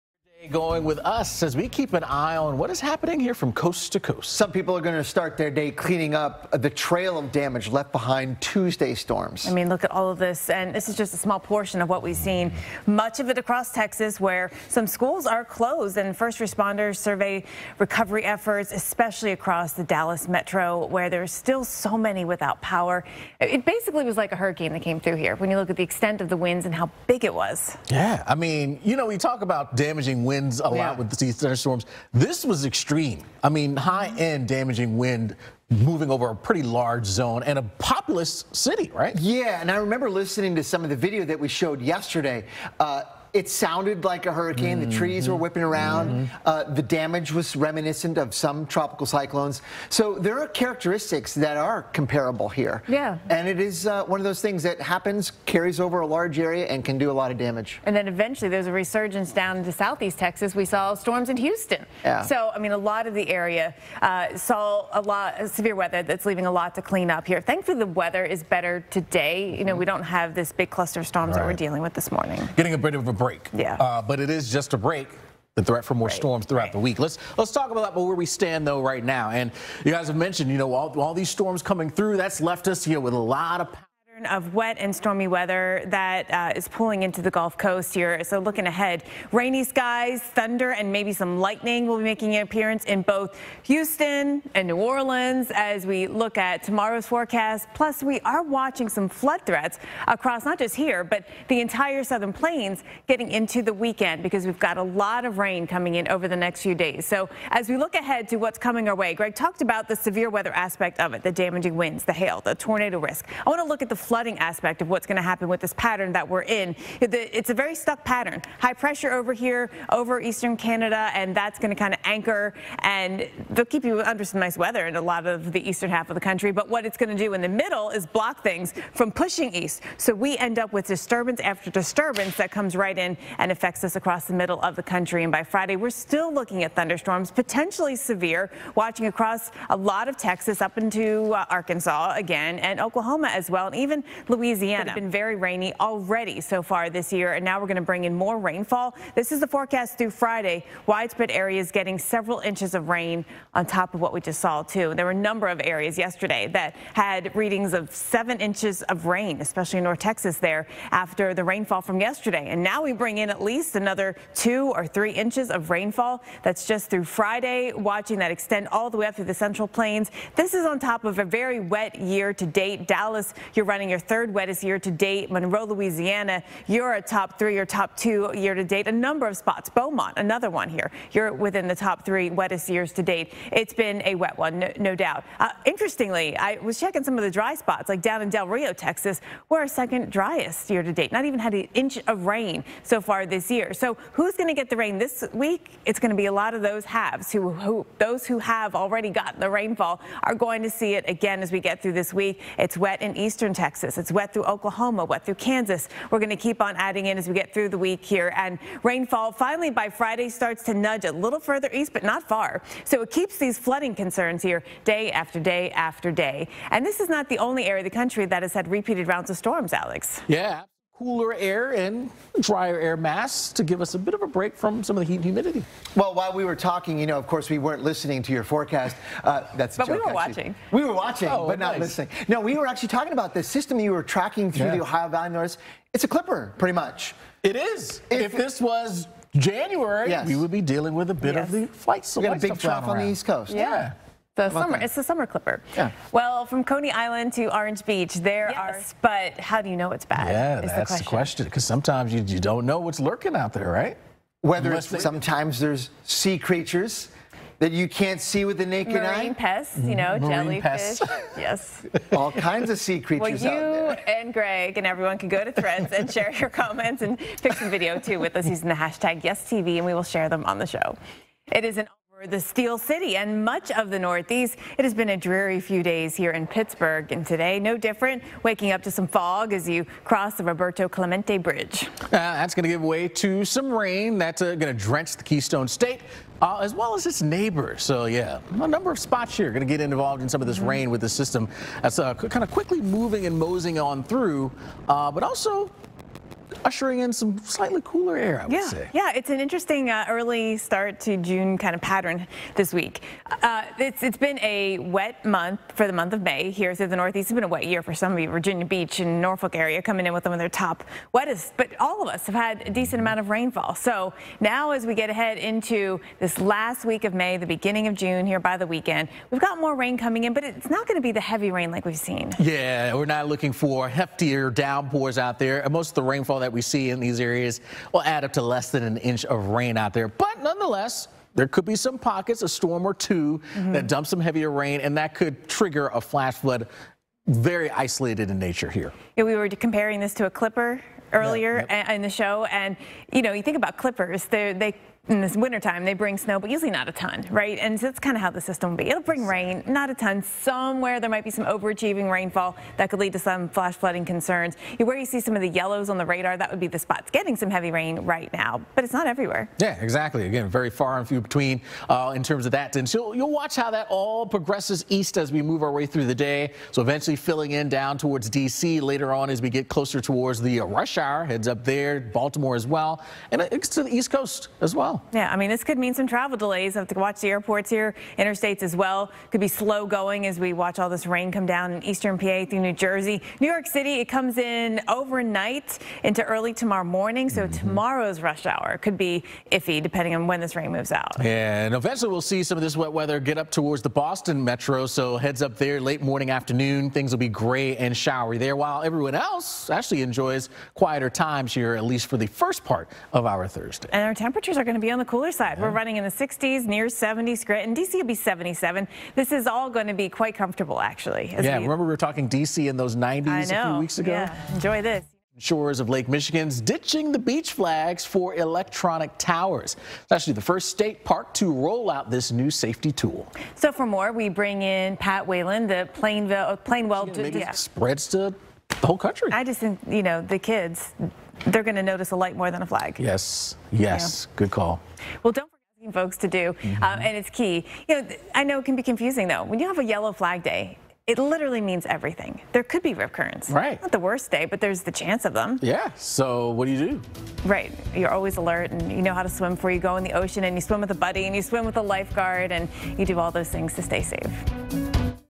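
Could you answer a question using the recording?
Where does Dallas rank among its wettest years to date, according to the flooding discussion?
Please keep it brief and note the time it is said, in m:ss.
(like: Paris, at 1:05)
third wettest, at 2:53.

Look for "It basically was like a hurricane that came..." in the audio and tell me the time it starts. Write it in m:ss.
0:23.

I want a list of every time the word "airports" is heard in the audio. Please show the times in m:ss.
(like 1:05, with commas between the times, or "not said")
6:17.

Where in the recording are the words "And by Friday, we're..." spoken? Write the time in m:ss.
2:15.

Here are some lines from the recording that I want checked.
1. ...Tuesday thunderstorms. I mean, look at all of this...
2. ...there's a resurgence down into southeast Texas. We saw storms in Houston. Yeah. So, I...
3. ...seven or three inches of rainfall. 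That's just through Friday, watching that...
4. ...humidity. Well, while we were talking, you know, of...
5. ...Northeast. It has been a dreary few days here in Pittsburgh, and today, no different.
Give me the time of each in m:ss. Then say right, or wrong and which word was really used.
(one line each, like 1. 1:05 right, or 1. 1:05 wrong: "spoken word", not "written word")
1. 0:08 wrong: "storms", not "thunderstorms"
2. 0:58 right
3. 2:44 wrong: "two", not "seven"
4. 3:45 right
5. 4:33 right.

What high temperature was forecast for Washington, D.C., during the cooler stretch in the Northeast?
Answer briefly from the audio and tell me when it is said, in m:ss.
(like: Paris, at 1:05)
77, at 6:48.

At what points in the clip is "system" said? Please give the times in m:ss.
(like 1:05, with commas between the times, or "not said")
3:53, 4:51, 5:48.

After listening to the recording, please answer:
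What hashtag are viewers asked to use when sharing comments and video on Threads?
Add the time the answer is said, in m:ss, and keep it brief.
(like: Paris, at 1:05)
YesTV, at 4:29.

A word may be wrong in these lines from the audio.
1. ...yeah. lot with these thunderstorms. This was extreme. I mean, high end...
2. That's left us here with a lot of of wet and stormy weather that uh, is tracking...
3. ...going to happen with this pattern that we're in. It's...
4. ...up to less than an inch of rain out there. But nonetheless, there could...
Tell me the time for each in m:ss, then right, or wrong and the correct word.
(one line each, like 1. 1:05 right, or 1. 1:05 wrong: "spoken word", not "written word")
1. 0:30 right
2. 1:22 wrong: "pulling", not "tracking"
3. 1:55 right
4. 5:28 right.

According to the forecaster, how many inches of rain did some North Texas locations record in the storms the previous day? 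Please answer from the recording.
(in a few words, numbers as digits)
7 inches.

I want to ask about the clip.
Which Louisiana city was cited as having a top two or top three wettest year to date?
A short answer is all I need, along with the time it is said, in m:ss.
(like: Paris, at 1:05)
Monroe, at 2:55.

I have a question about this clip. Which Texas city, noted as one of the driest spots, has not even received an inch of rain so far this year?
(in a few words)
Del Rio.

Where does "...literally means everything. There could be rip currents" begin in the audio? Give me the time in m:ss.
7:21.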